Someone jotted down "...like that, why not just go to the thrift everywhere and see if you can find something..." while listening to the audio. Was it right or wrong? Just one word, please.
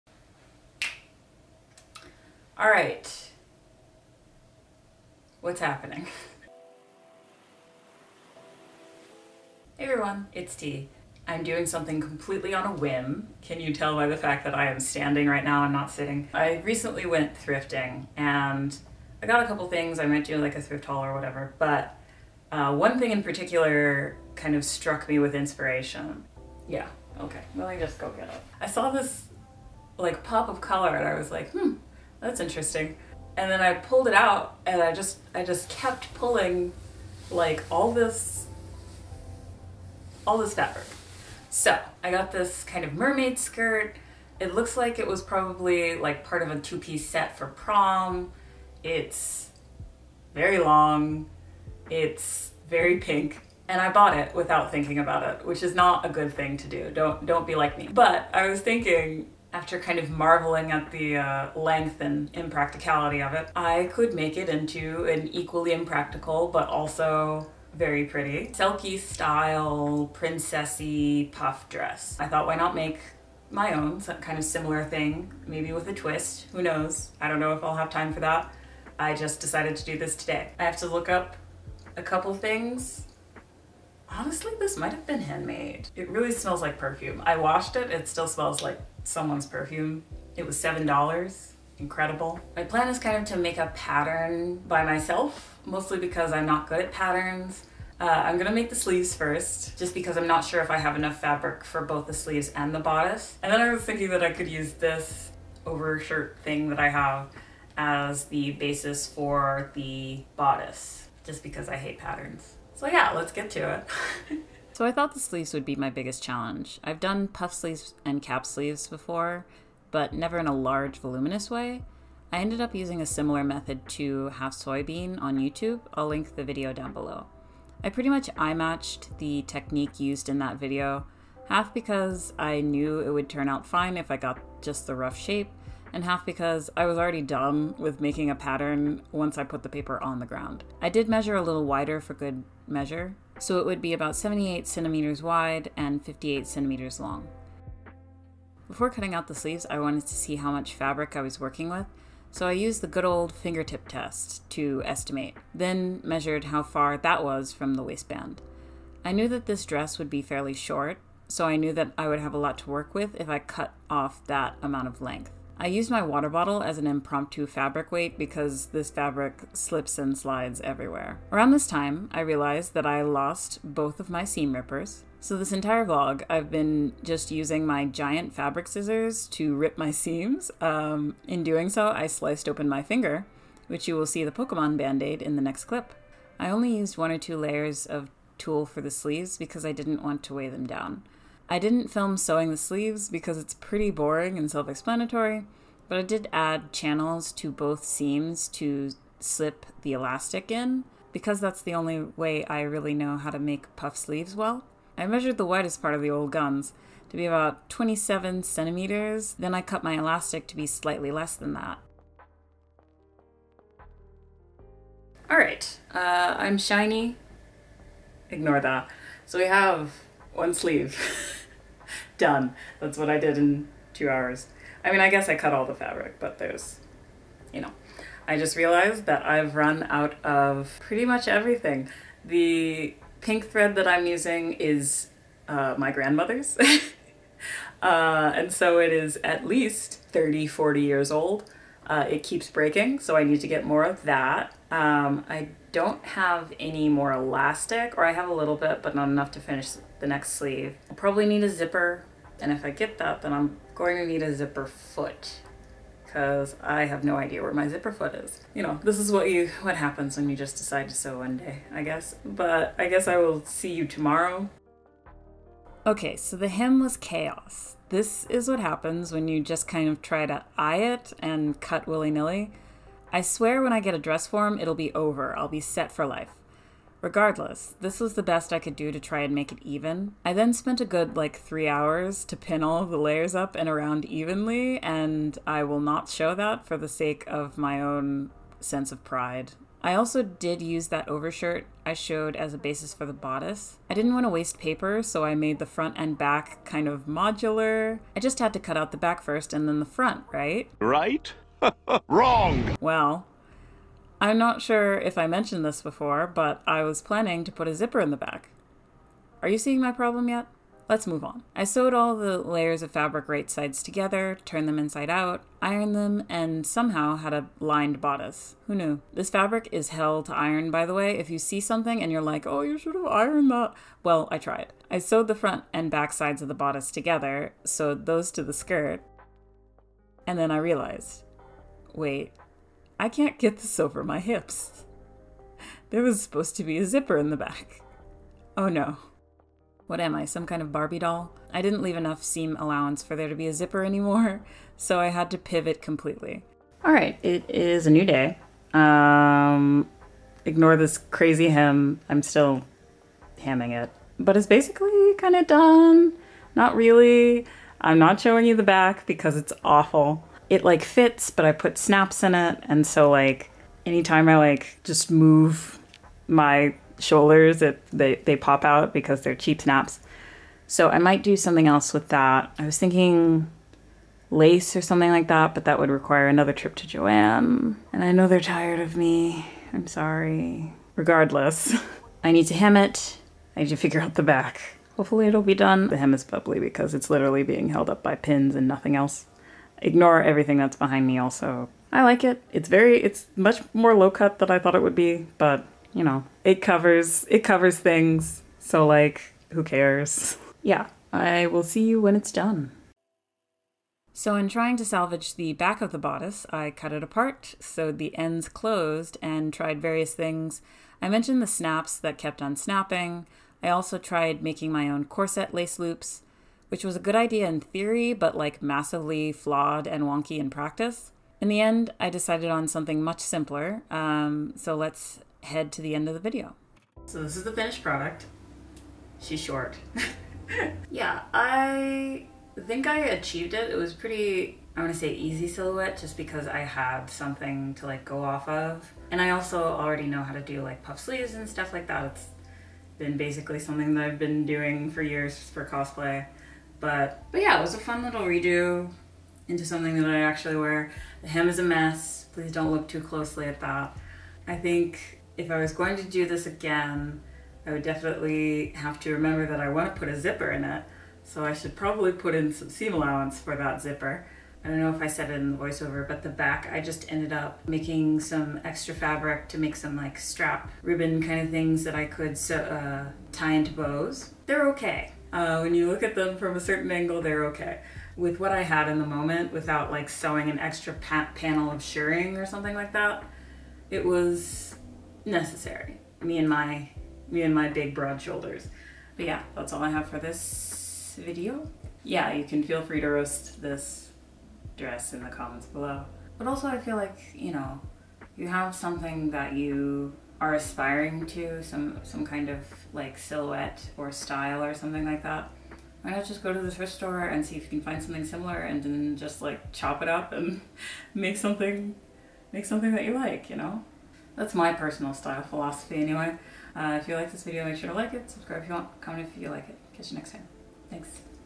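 wrong.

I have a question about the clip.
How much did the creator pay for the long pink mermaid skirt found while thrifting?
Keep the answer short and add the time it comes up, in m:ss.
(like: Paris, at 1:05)
$7, at 1:30.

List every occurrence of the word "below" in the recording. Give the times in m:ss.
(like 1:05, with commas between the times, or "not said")
2:06, 8:15.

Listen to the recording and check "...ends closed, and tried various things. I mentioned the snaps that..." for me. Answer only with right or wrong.
right.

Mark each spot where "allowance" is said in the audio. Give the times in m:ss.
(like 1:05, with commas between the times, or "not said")
5:42, 7:42.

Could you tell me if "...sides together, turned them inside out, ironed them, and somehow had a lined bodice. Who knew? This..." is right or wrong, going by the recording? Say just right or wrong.
right.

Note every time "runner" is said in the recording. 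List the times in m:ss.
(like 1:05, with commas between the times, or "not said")
not said.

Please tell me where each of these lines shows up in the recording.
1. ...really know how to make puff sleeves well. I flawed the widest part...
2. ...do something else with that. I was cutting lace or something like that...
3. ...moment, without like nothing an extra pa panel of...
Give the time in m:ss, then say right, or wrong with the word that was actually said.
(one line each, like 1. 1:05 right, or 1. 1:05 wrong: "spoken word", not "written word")
1. 3:22 wrong: "measured", not "flawed"
2. 6:11 wrong: "thinking", not "cutting"
3. 7:59 wrong: "sewing", not "nothing".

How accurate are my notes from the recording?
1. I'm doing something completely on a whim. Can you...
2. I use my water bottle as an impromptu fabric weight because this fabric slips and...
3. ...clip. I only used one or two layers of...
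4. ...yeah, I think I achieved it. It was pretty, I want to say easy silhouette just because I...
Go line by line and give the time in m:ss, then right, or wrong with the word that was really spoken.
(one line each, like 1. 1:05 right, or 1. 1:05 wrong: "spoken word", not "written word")
1. 0:11 right
2. 2:45 right
3. 3:05 right
4. 7:10 right.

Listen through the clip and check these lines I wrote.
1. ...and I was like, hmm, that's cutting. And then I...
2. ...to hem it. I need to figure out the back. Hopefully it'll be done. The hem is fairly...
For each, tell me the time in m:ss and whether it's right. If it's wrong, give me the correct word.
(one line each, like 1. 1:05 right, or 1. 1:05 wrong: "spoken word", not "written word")
1. 0:30 wrong: "interesting", not "cutting"
2. 6:22 wrong: "bubbly", not "fairly".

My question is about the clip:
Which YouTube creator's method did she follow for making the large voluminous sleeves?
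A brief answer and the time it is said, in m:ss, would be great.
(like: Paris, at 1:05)
Halfsoybean, at 2:04.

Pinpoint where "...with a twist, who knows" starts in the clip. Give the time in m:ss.
1:15.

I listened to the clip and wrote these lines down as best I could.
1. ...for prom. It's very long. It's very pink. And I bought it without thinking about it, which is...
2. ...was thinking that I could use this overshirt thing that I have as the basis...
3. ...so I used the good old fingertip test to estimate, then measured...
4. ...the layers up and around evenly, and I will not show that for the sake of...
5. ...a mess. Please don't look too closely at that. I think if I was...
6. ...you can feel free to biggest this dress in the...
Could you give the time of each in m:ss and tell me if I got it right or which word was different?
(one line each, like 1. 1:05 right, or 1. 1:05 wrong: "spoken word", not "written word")
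1. 0:47 right
2. 1:43 right
3. 2:32 right
4. 4:42 right
5. 7:31 right
6. 8:12 wrong: "roast", not "biggest".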